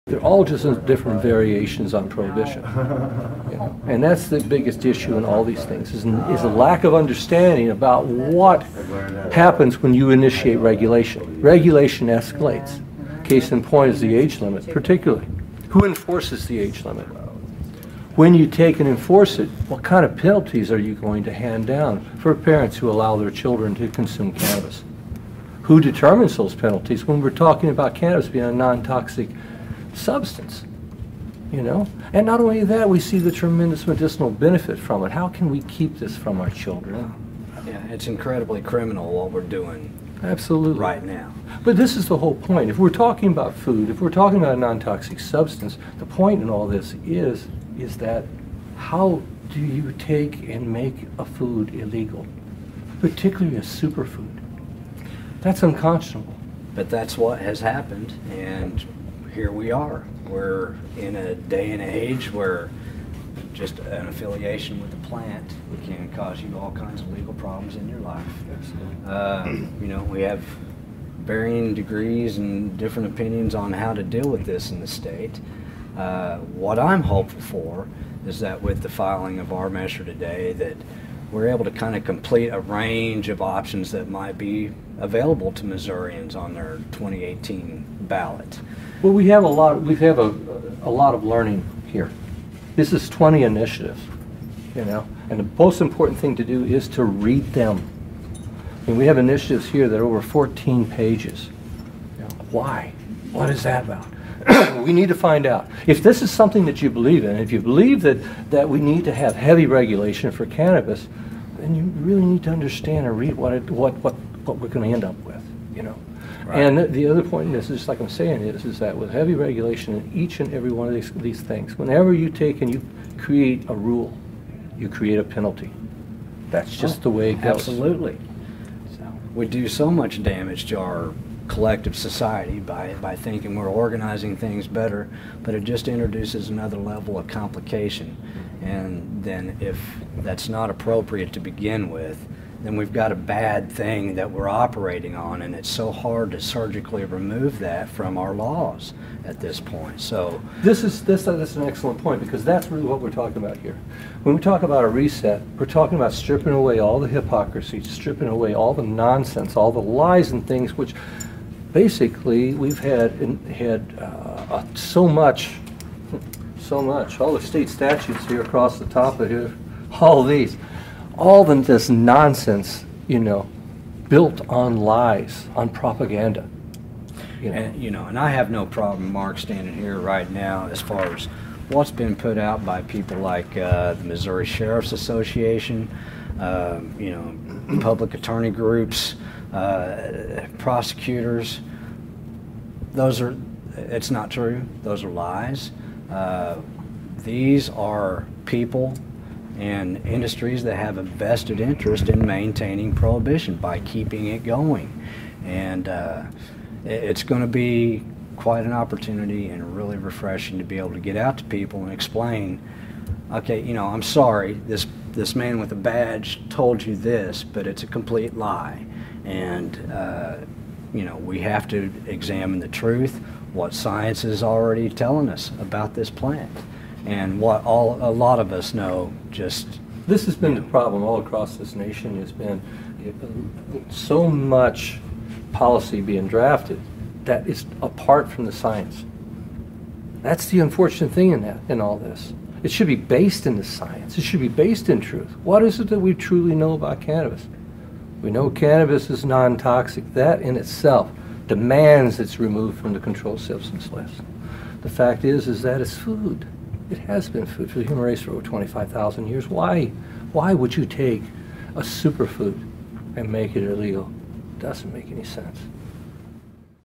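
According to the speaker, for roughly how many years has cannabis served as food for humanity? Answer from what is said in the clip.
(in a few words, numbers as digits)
25,000 years.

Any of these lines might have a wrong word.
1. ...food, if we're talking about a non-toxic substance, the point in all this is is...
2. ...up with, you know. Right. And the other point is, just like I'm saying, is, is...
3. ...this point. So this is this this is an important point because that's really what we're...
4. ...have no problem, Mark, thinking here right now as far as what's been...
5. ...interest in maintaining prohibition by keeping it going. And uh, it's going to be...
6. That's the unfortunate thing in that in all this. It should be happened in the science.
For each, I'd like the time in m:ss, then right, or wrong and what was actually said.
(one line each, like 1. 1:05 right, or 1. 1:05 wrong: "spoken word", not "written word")
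1. 0:43 right
2. 1:55 right
3. 2:29 wrong: "excellent", not "important"
4. 2:58 wrong: "standing", not "thinking"
5. 3:21 right
6. 4:00 wrong: "based", not "happened".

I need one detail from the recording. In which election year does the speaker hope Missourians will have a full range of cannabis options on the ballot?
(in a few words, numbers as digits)
2018.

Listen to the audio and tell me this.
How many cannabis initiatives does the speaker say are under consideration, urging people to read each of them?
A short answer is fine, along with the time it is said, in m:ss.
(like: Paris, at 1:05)
20, at 1:33.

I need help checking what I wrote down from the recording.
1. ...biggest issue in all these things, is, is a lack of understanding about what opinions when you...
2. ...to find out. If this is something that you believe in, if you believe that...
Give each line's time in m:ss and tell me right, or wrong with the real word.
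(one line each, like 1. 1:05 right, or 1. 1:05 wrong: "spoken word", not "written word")
1. 0:04 wrong: "happens", not "opinions"
2. 1:45 right.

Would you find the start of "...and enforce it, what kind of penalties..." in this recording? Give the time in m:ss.
0:18.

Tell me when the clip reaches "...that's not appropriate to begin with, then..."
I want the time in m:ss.
2:20.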